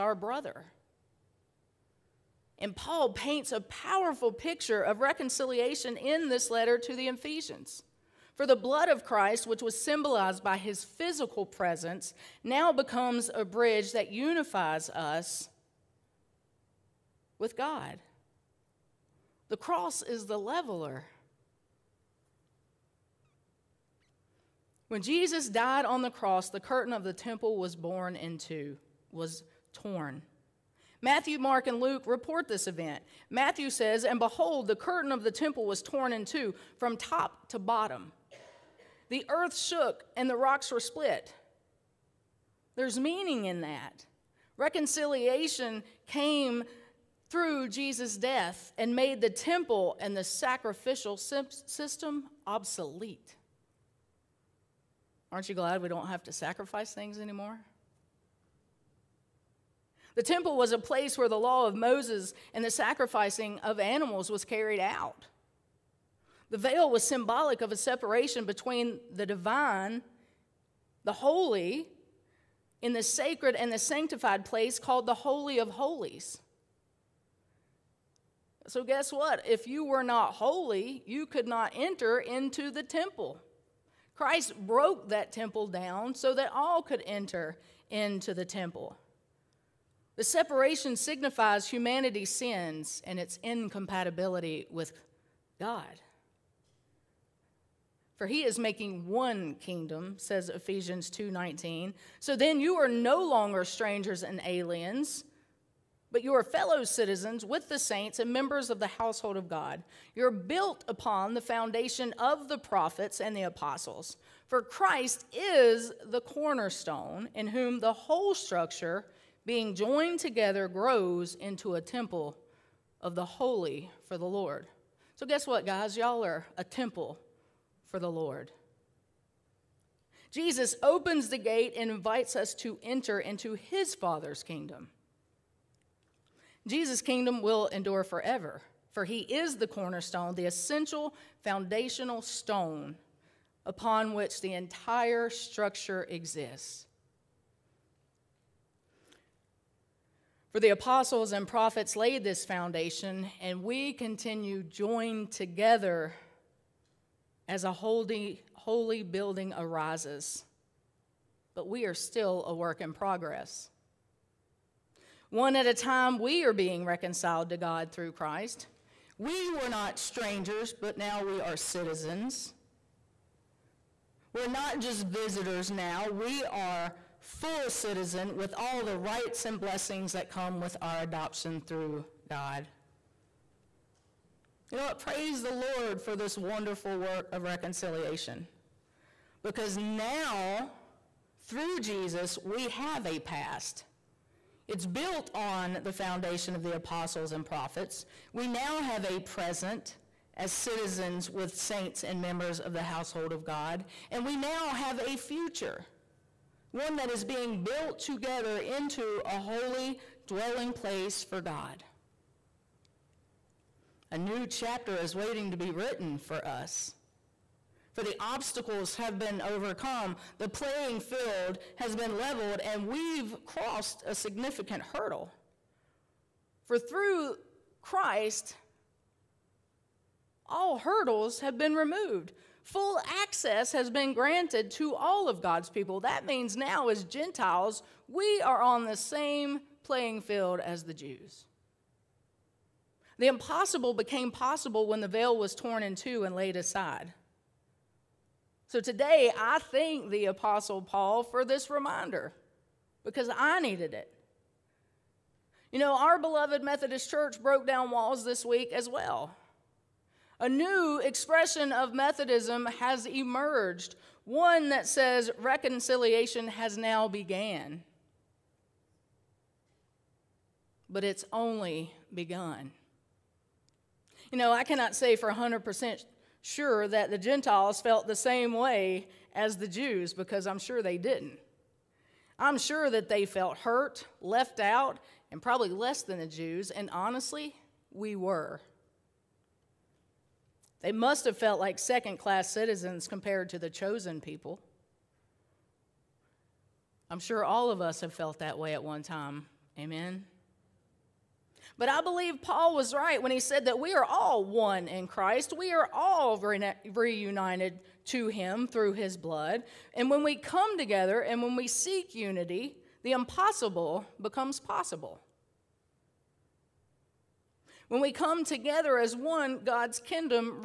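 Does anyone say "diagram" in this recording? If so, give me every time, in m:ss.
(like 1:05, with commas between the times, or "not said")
not said.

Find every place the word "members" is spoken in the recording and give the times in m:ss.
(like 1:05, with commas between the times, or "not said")
1:48, 3:22.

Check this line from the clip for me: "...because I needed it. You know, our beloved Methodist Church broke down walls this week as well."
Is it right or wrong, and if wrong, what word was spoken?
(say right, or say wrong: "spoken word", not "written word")
right.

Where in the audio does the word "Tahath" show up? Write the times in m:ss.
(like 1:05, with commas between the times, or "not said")
not said.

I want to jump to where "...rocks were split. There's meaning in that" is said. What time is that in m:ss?
0:40.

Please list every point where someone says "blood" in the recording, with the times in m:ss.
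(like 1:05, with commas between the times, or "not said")
0:08, 5:09.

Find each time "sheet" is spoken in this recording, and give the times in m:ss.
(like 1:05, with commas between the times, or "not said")
not said.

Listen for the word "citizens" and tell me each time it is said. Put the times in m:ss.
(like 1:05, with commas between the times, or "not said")
1:46, 2:51, 2:57, 3:20, 4:52.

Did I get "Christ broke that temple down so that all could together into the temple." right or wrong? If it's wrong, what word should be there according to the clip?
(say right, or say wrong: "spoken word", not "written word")
wrong: "enter", not "together".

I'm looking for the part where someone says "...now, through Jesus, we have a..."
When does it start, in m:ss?
3:09.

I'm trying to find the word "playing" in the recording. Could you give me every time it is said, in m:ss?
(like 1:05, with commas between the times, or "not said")
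3:40, 3:59.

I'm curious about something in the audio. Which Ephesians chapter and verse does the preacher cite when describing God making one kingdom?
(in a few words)
Ephesians 2:19.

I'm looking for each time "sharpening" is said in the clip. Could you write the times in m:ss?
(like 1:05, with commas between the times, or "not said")
not said.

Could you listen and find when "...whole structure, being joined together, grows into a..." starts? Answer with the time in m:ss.
1:57.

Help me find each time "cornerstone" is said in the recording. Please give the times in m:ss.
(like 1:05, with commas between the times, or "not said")
1:56, 2:19.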